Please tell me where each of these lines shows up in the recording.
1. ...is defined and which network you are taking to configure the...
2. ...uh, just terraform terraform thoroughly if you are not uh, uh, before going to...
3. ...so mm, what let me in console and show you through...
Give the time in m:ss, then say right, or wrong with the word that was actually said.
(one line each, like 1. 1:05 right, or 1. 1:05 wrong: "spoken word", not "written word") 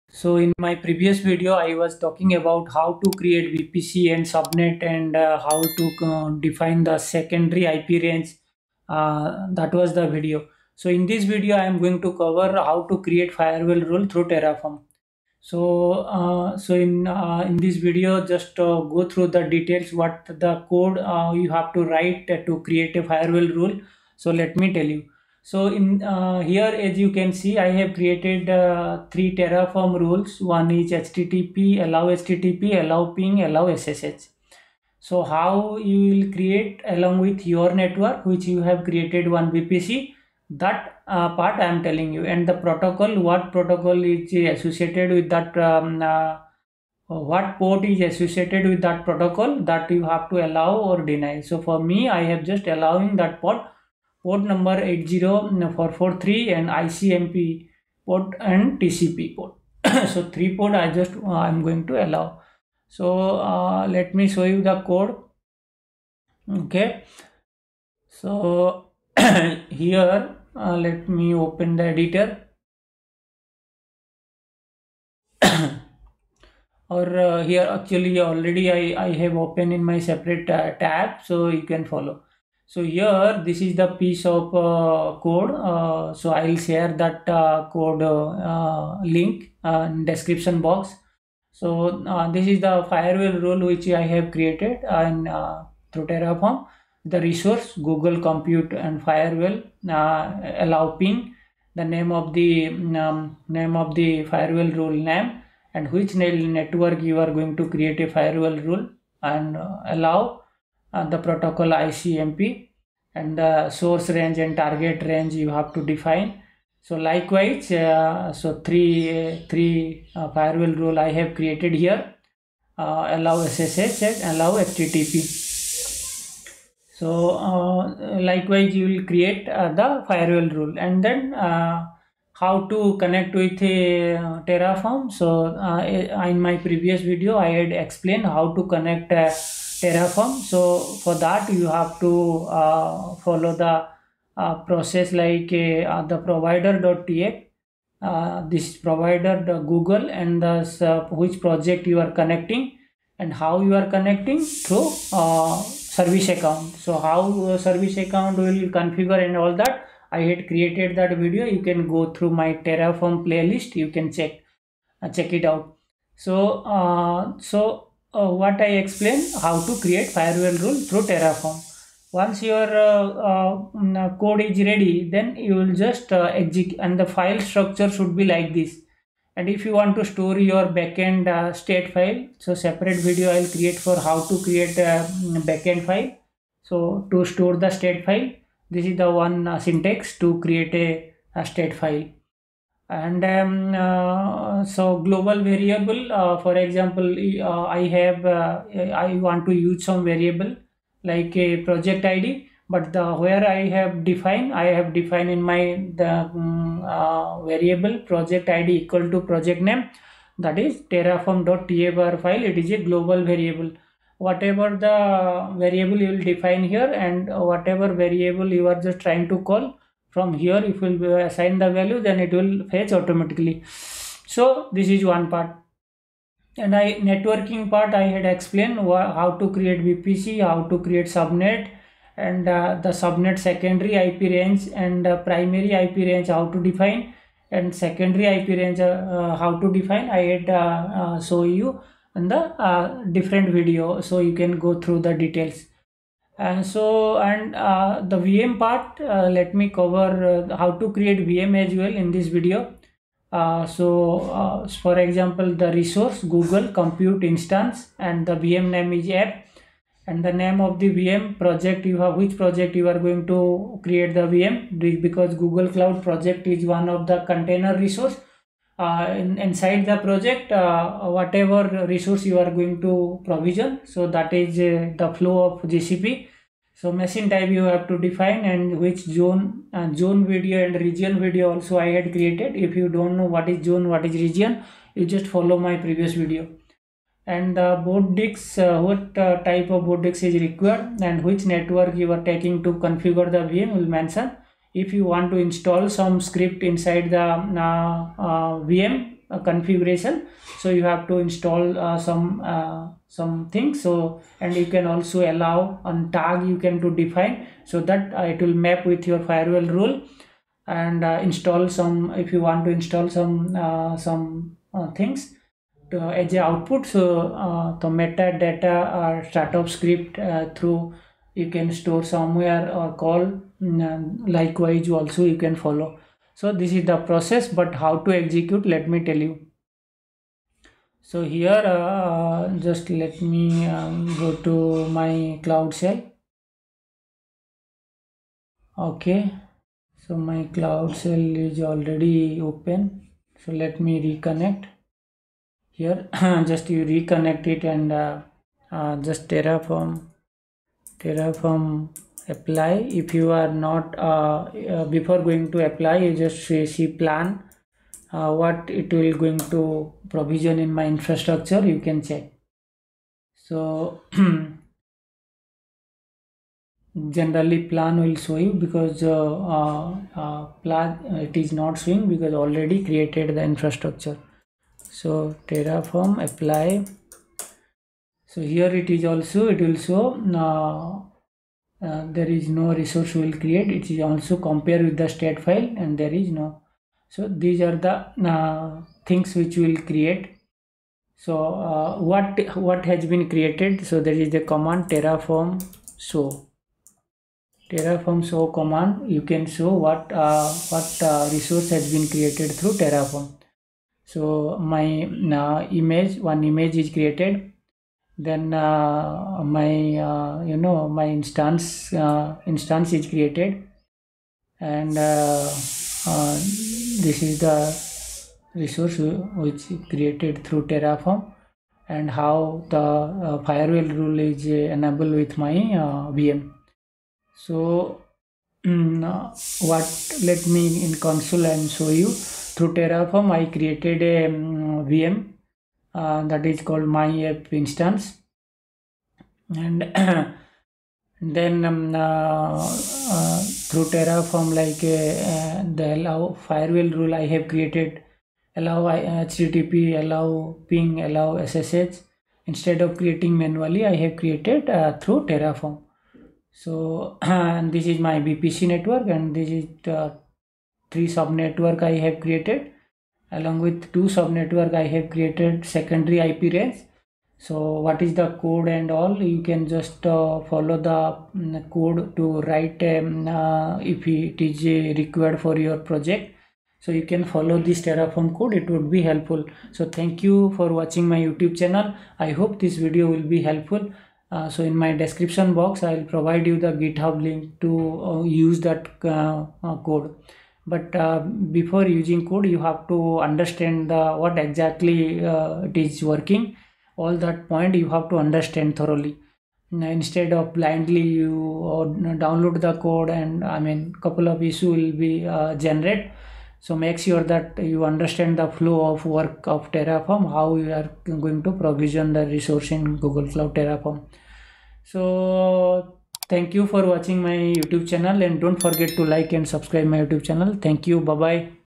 1. 4:50 wrong: "required", not "defined"
2. 5:48 wrong: "apply", not "thoroughly"
3. 7:07 right.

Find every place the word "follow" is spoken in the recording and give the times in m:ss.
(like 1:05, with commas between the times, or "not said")
1:21, 2:23, 4:45, 5:25, 7:50, 7:57.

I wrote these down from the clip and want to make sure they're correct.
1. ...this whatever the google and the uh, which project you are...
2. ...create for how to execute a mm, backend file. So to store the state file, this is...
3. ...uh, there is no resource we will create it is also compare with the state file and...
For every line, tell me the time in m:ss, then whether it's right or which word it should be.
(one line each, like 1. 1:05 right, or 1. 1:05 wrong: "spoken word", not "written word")
1. 2:28 wrong: "provider", not "whatever"
2. 3:03 wrong: "create", not "execute"
3. 6:21 right.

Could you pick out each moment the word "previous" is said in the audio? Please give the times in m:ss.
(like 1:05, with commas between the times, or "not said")
0:00, 2:16, 4:45.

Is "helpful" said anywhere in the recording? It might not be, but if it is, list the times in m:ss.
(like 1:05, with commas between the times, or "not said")
7:59, 8:03.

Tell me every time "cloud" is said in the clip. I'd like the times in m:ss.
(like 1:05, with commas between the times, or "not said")
4:25, 5:35, 5:40, 8:33.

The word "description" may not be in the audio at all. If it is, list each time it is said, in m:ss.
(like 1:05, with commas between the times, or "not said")
1:30, 8:04.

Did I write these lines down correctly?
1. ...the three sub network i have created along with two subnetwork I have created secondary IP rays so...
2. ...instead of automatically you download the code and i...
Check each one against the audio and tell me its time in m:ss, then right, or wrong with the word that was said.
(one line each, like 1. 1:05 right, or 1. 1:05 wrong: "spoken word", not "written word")
1. 7:39 right
2. 8:19 wrong: "blindly", not "automatically".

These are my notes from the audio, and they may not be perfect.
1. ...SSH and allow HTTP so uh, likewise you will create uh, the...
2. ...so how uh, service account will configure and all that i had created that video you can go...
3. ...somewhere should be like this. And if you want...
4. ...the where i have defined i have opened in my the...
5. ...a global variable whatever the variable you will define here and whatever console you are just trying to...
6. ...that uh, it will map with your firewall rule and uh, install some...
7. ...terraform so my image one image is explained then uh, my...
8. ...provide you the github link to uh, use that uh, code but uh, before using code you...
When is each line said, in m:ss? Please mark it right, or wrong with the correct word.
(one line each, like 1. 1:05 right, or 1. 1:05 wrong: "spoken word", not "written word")
1. 2:03 right
2. 2:36 right
3. 2:57 wrong: "structure", not "somewhere"
4. 3:22 wrong: "defined", not "opened"
5. 3:32 wrong: "variable", not "console"
6. 5:07 right
7. 6:42 wrong: "created", not "explained"
8. 8:06 right.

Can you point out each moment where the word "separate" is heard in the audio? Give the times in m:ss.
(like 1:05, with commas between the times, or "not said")
1:19, 3:02.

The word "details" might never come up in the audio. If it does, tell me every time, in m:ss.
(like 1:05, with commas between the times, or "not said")
0:19, 4:05.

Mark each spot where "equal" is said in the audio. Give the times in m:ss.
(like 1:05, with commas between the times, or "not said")
3:28.